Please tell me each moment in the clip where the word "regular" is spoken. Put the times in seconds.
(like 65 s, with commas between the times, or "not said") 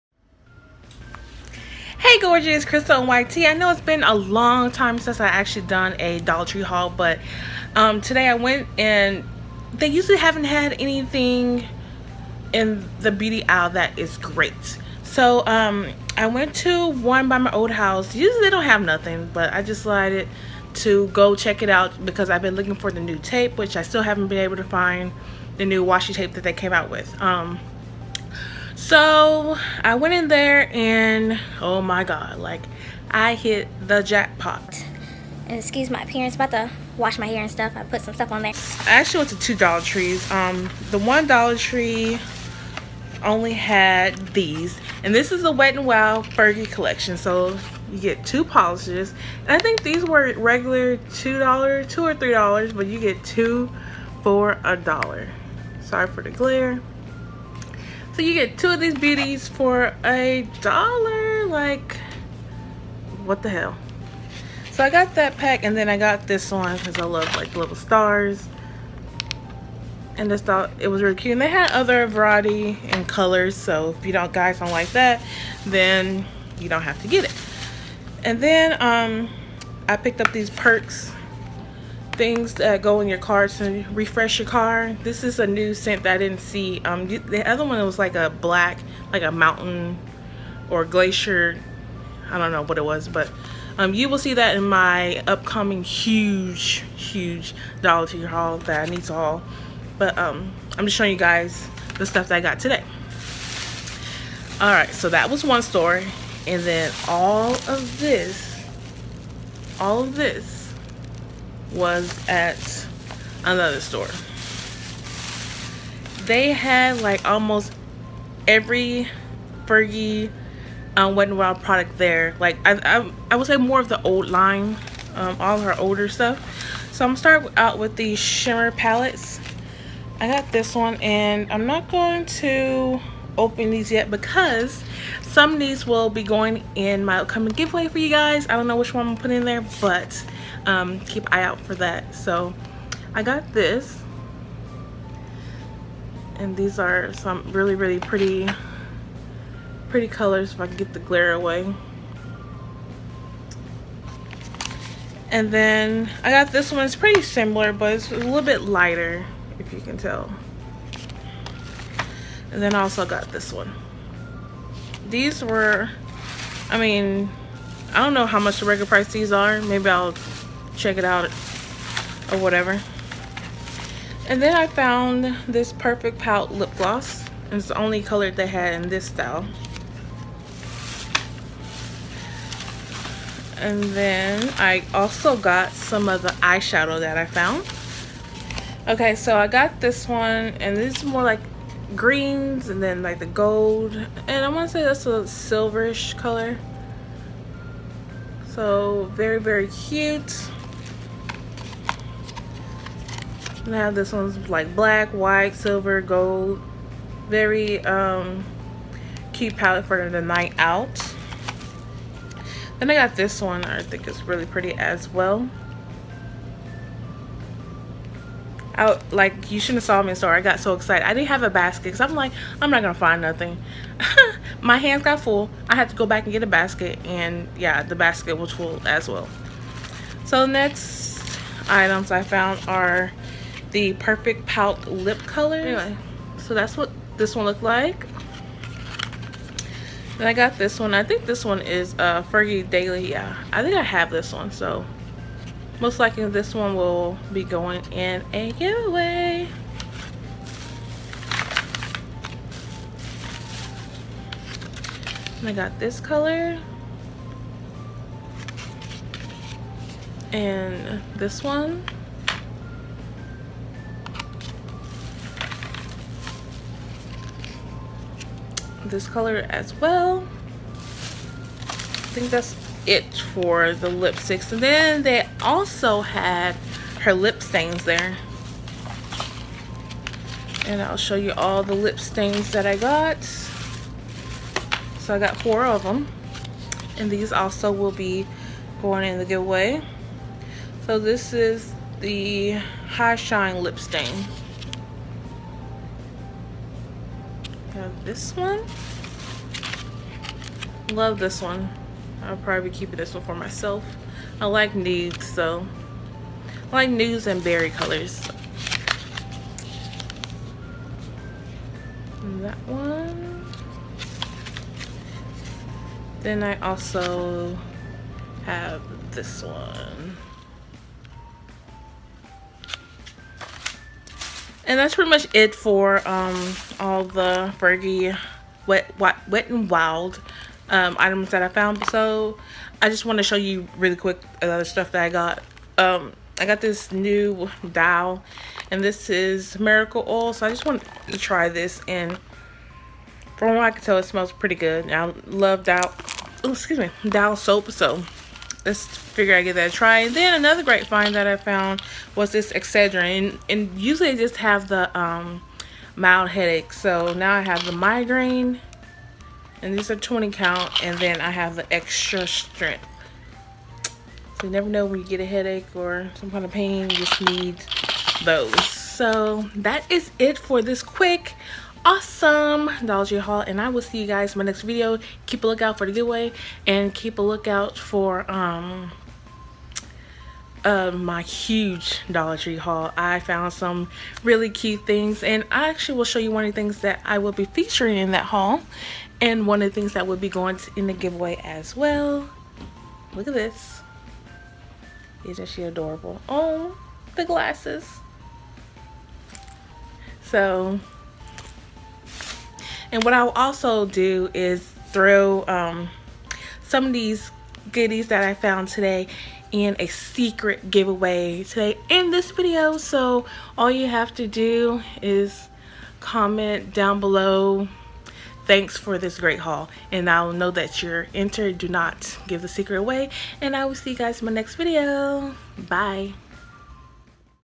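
50 s, 168 s.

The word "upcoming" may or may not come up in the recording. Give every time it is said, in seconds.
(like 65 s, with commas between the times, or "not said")
95 s, 137 s.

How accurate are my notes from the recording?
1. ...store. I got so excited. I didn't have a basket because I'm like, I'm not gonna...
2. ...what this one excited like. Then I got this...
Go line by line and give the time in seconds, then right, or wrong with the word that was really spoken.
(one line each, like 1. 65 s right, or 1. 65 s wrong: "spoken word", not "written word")
1. 220 s right
2. 236 s wrong: "looked", not "excited".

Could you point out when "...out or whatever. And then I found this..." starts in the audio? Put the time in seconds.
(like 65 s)
171 s.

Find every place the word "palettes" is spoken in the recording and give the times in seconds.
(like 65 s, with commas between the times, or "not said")
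128 s, 209 s.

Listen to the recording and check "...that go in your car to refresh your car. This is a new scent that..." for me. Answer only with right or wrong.
right.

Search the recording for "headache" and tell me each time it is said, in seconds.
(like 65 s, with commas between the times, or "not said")
356 s, 365 s.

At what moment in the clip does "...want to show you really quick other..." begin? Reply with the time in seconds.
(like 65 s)
333 s.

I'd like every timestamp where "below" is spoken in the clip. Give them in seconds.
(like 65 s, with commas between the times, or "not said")
416 s.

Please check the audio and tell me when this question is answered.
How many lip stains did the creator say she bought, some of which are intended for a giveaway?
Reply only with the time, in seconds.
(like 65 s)
285 s.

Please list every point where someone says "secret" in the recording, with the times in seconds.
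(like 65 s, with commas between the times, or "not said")
409 s, 422 s.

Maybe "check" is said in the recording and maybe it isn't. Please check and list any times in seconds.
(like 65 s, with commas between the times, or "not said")
21 s, 170 s.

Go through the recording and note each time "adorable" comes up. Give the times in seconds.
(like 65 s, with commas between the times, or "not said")
395 s.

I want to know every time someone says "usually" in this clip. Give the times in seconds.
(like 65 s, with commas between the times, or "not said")
9 s, 18 s, 353 s.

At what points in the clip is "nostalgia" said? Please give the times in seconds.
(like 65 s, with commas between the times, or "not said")
not said.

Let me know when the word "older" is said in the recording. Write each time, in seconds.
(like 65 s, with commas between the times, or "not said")
125 s.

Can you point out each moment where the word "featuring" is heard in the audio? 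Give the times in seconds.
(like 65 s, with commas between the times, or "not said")
387 s.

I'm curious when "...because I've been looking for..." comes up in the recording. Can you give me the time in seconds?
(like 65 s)
22 s.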